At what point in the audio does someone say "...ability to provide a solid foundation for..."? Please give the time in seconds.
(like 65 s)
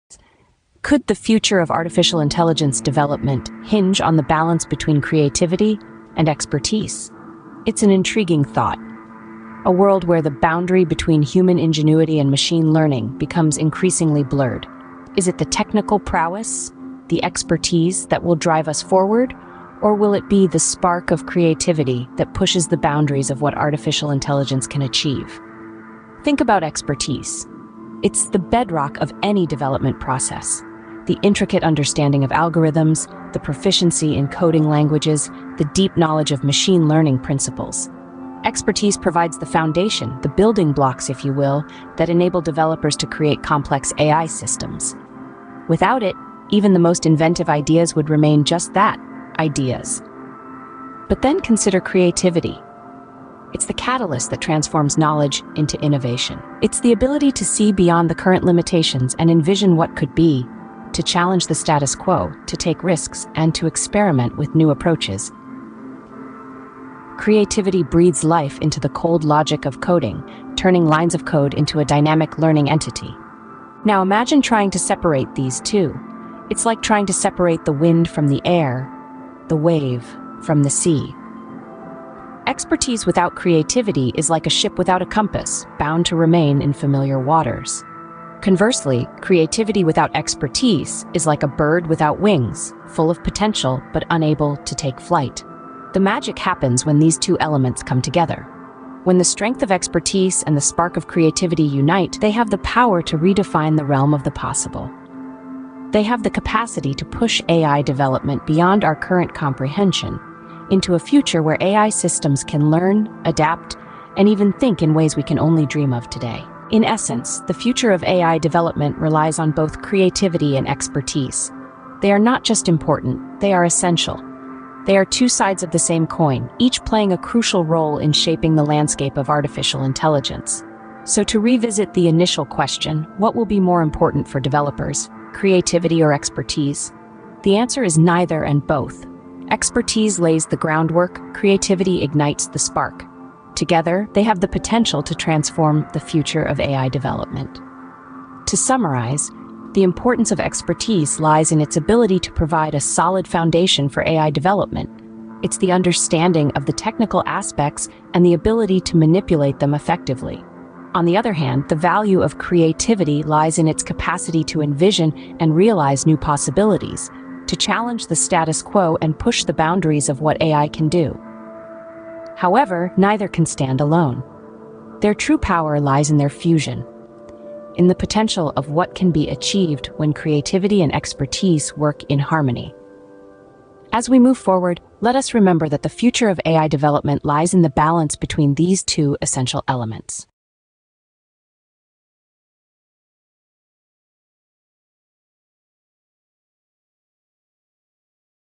151 s.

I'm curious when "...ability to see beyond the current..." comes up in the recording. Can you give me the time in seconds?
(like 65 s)
56 s.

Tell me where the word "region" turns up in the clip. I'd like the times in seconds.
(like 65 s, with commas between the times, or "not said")
not said.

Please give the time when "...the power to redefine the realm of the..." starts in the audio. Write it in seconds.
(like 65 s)
102 s.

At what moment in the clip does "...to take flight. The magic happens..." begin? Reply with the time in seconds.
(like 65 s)
94 s.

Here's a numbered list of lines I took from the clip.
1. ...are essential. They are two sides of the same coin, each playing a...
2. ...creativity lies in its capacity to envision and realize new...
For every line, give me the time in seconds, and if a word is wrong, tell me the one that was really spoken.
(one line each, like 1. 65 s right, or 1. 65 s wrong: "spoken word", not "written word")
1. 123 s right
2. 162 s right.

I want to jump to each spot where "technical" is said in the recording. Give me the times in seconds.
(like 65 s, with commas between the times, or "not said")
15 s, 156 s.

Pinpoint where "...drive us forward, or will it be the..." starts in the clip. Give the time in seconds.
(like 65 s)
18 s.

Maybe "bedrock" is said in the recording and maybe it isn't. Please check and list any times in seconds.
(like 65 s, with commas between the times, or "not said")
28 s.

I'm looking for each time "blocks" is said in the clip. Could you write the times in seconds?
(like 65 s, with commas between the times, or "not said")
40 s.